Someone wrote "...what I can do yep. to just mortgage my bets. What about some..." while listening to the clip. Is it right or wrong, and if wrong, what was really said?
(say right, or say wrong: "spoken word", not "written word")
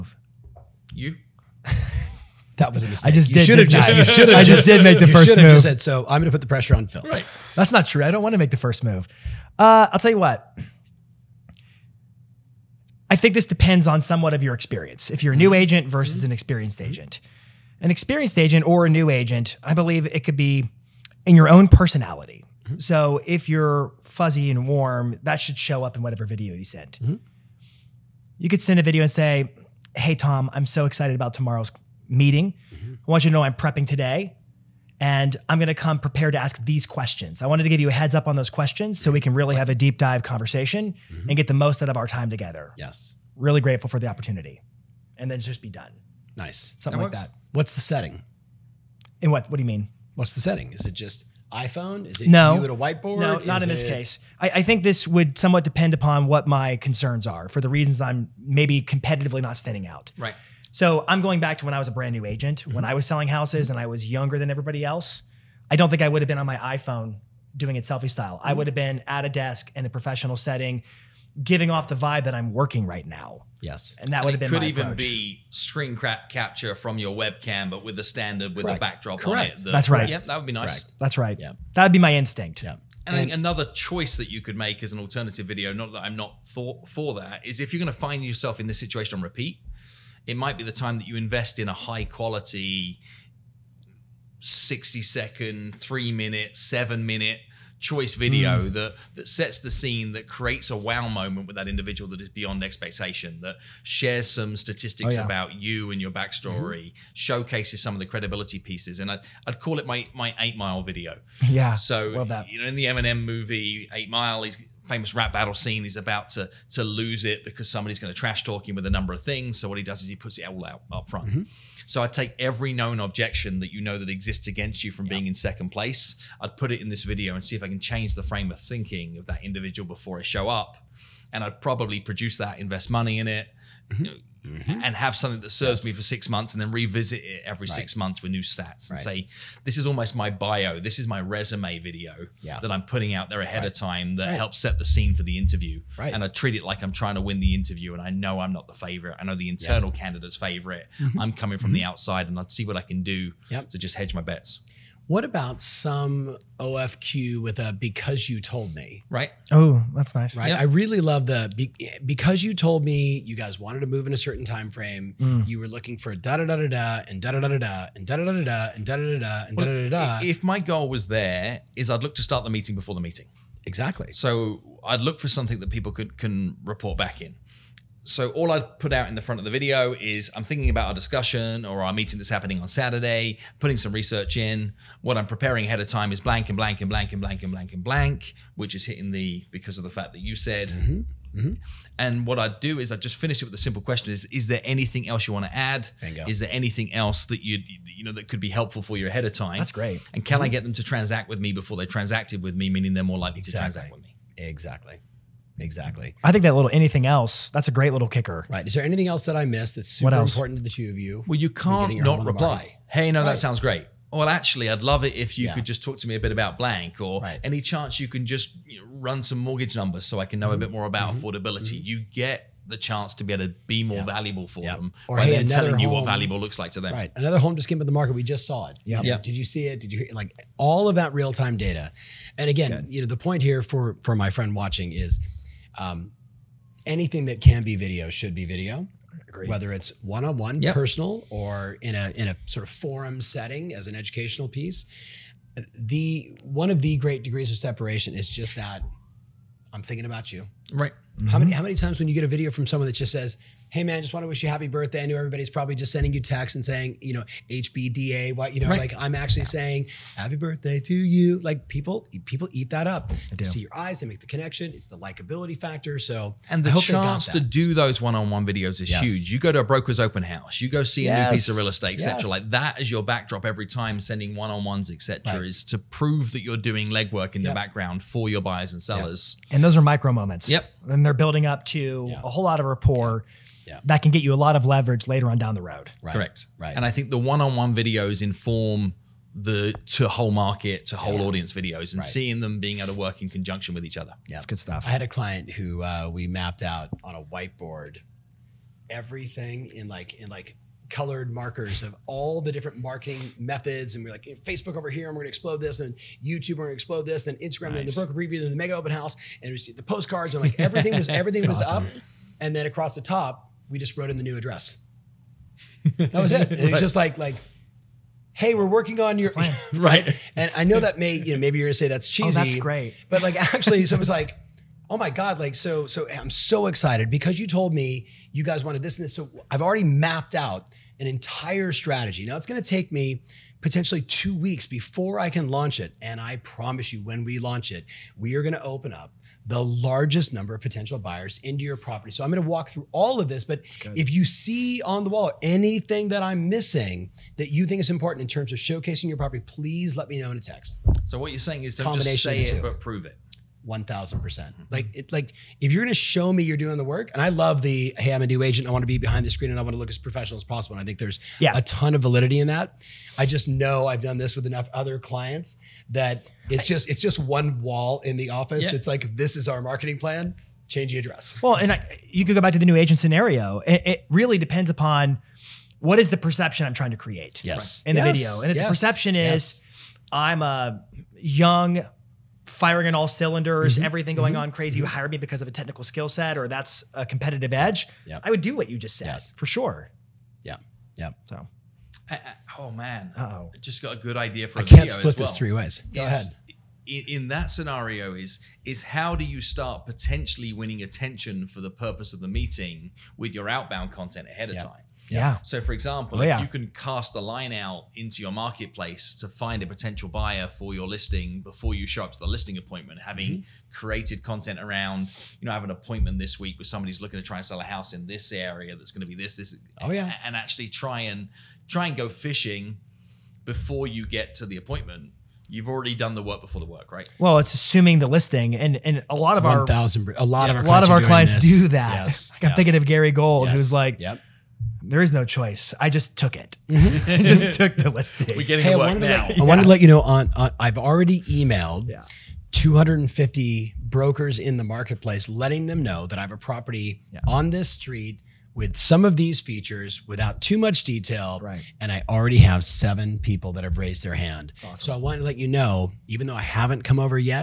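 wrong: "hedge", not "mortgage".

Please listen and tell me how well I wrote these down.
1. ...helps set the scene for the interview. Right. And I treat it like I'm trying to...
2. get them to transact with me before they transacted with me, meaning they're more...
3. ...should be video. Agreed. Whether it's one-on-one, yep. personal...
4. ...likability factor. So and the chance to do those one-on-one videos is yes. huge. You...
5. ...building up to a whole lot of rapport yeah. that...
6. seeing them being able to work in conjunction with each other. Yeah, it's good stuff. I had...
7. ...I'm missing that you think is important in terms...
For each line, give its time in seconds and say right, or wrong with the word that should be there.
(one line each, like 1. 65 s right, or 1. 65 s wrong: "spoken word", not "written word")
1. 144 s right
2. 200 s right
3. 238 s right
4. 264 s right
5. 281 s right
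6. 292 s right
7. 346 s right.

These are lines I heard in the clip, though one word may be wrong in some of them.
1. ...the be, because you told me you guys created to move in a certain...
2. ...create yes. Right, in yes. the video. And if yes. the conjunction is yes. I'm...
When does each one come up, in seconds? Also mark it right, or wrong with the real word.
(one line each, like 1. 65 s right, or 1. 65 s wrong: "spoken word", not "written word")
1. 161 s wrong: "wanted", not "created"
2. 376 s wrong: "perception", not "conjunction".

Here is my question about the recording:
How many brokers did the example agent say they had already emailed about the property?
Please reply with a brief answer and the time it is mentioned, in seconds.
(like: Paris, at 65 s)
250, at 442 s.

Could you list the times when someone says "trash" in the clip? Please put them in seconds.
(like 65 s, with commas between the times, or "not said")
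118 s.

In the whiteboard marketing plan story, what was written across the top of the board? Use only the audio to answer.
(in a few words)
The new address.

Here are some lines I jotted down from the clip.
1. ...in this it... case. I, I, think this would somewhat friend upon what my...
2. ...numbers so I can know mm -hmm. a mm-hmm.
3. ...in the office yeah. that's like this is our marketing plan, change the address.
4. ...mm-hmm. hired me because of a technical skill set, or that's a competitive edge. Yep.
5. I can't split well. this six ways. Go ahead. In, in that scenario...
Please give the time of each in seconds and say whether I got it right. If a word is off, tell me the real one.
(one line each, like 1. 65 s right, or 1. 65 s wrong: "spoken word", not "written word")
1. 53 s wrong: "depend", not "friend"
2. 219 s right
3. 368 s right
4. 384 s right
5. 394 s wrong: "three", not "six".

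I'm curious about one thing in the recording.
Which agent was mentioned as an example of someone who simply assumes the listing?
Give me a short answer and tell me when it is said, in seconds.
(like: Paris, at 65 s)
Gary Gold, at 432 s.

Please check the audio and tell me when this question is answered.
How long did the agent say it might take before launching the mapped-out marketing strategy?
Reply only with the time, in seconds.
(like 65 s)
334 s.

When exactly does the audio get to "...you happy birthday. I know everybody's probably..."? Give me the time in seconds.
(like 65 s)
254 s.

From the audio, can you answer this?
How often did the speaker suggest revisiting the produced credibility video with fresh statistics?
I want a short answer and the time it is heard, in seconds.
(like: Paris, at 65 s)
Every 6 months, at 137 s.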